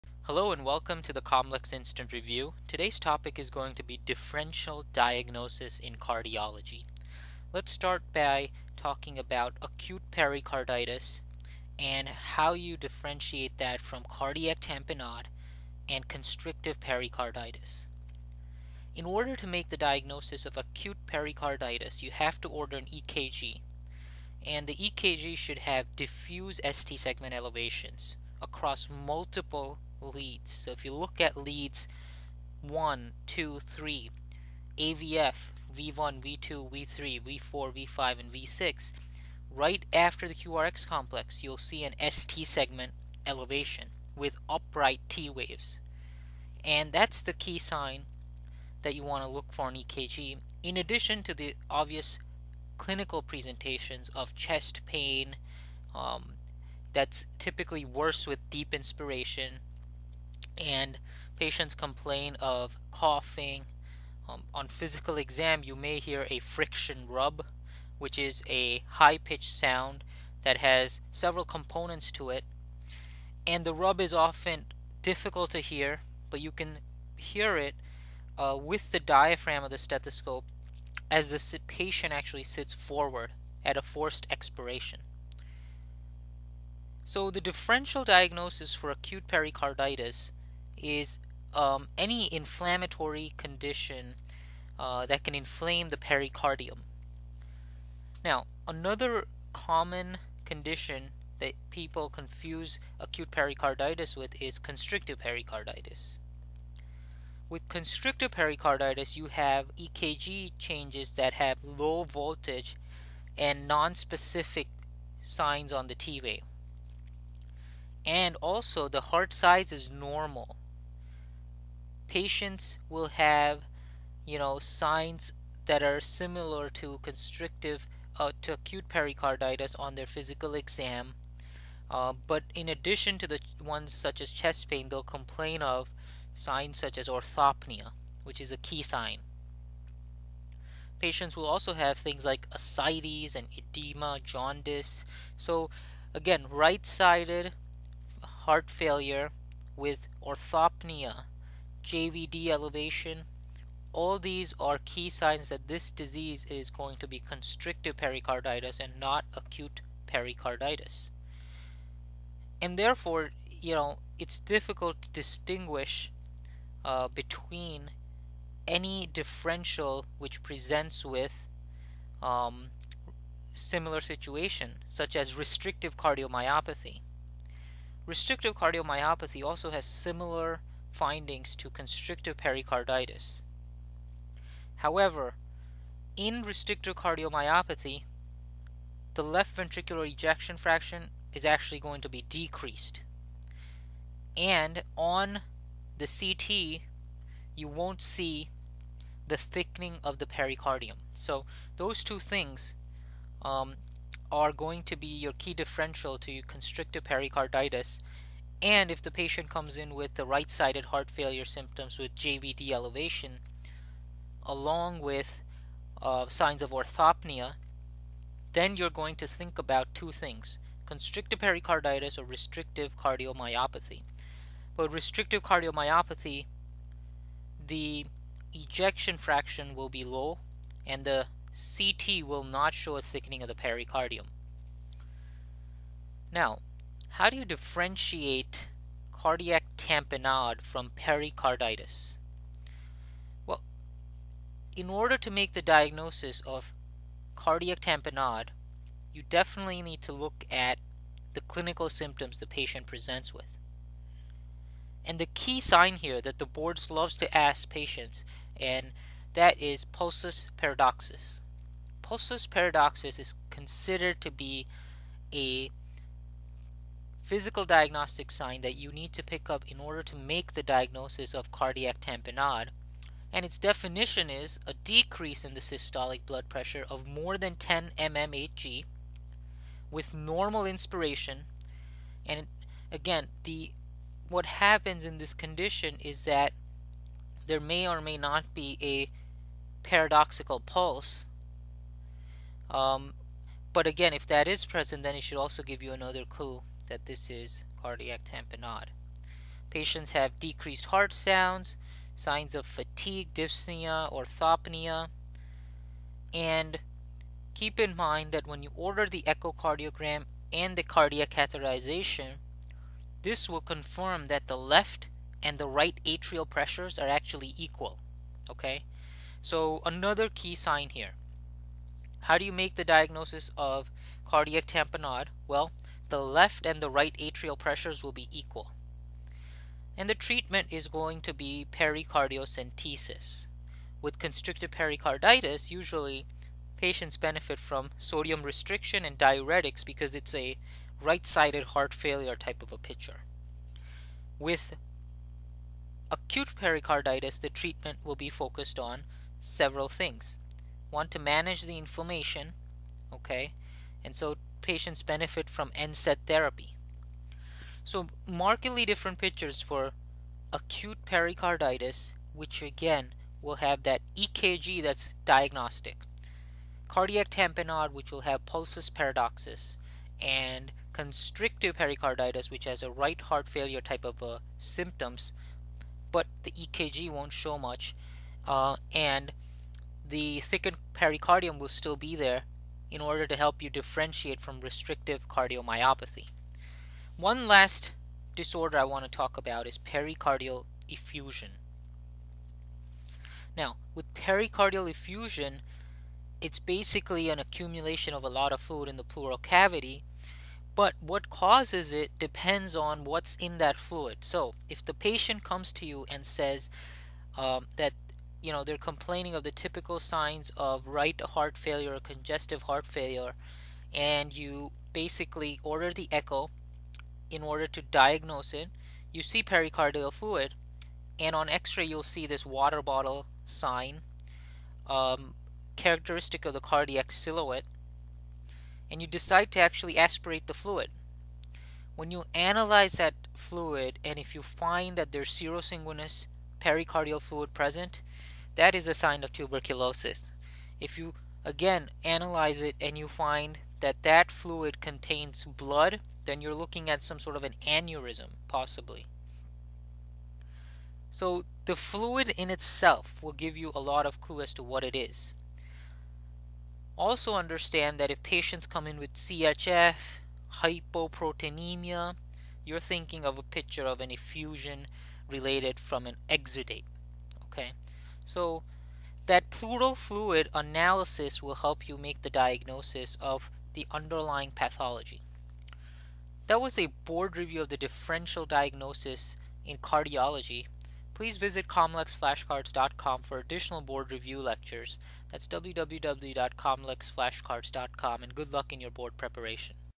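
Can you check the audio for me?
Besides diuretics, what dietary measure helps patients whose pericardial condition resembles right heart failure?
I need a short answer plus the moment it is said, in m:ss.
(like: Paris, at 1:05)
sodium restriction, at 5:37.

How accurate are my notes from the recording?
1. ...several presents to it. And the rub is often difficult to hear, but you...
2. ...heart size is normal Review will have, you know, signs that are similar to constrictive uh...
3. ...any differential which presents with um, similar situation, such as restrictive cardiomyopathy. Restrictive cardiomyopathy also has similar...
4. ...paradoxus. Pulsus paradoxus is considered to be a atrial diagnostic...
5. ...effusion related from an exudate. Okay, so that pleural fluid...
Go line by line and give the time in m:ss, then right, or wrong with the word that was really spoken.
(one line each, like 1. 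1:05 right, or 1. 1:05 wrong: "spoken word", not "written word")
1. 1:11 wrong: "components", not "presents"
2. 1:59 wrong: "Patients", not "Review"
3. 2:48 right
4. 4:20 wrong: "physical", not "atrial"
5. 7:44 right.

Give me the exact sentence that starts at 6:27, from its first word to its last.
One last disorder I want to talk about is pericardial effusion.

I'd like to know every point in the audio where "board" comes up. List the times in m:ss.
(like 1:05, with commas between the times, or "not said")
4:16, 7:56, 8:03, 8:08.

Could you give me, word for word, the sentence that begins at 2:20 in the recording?
Patients will also have things like ascites and edema, jaundice.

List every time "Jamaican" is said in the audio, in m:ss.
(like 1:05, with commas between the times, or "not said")
not said.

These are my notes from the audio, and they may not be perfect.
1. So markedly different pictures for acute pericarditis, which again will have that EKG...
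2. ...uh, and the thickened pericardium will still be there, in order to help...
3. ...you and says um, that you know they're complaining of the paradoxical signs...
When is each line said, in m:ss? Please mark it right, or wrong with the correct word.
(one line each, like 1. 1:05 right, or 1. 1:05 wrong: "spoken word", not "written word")
1. 5:57 right
2. 6:18 right
3. 6:45 wrong: "typical", not "paradoxical".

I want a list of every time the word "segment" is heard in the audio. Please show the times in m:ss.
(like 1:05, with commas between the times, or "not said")
0:26, 0:42.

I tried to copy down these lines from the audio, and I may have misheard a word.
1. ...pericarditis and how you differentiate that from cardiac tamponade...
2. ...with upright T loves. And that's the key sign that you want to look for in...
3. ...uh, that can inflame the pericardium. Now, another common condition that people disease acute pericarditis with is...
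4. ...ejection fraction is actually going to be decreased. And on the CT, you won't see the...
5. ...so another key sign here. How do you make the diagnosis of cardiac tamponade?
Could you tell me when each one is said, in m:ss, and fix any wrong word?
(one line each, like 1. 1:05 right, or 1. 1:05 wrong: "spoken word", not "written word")
1. 0:10 right
2. 0:44 wrong: "waves", not "loves"
3. 1:34 wrong: "confuse", not "disease"
4. 3:10 right
5. 5:19 right.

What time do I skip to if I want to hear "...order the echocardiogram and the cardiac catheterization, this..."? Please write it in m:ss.
5:08.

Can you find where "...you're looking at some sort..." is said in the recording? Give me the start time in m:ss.
7:26.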